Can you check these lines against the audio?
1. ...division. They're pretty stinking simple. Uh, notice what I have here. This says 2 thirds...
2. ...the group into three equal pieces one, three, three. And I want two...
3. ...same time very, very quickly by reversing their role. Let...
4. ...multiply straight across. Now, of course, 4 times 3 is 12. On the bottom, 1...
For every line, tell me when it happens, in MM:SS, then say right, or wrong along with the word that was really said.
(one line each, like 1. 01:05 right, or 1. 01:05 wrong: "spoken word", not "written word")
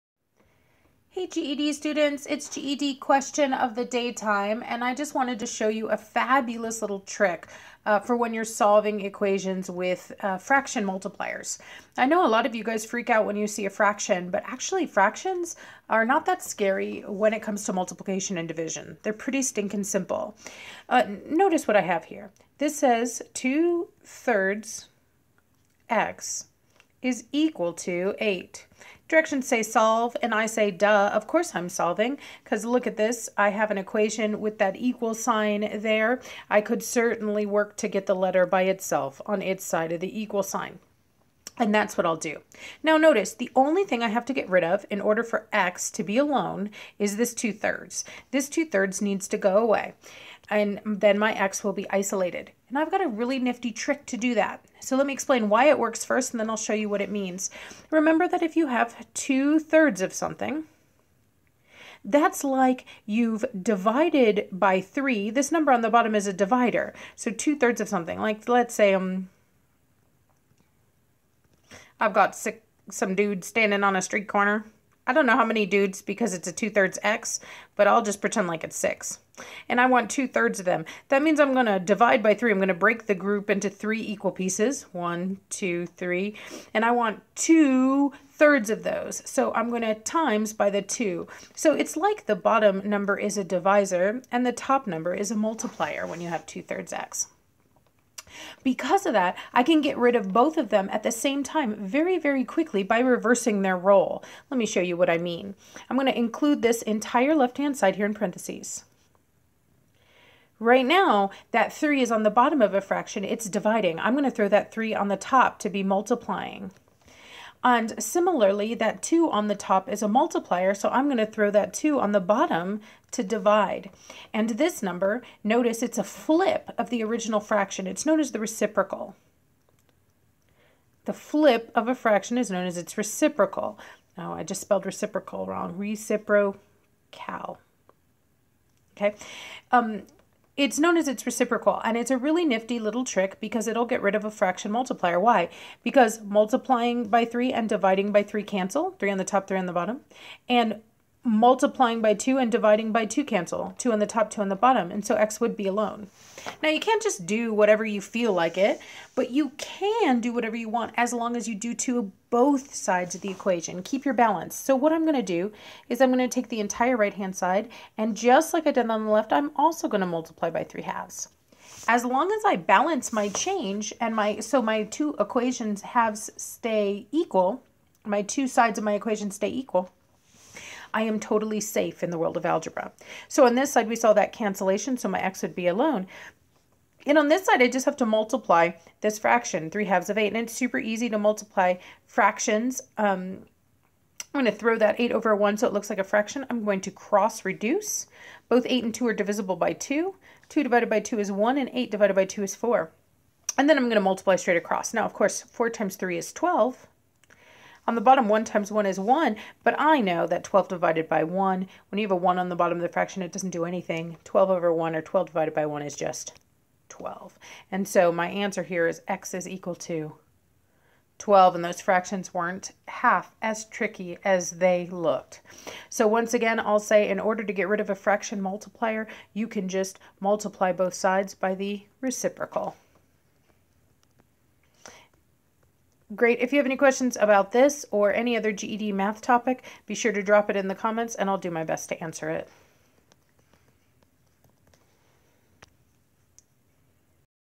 1. 00:18 right
2. 01:23 wrong: "two", not "three"
3. 01:41 right
4. 03:24 right.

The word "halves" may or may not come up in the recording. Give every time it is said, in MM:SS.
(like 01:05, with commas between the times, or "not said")
02:50, 02:55, 03:09.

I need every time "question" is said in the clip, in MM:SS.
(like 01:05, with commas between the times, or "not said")
00:02, 03:56.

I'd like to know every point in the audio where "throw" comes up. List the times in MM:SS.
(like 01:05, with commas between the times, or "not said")
01:54, 02:01, 03:14.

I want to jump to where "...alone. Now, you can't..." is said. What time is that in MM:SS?
02:35.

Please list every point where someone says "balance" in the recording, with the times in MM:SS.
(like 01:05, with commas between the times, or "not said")
02:44, 02:52.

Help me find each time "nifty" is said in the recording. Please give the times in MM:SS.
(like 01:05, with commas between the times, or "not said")
00:53, 02:22.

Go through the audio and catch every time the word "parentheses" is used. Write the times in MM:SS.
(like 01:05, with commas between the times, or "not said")
01:48.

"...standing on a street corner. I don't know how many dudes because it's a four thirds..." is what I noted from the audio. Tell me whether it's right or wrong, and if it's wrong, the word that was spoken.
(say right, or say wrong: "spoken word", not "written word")
wrong: "two", not "four".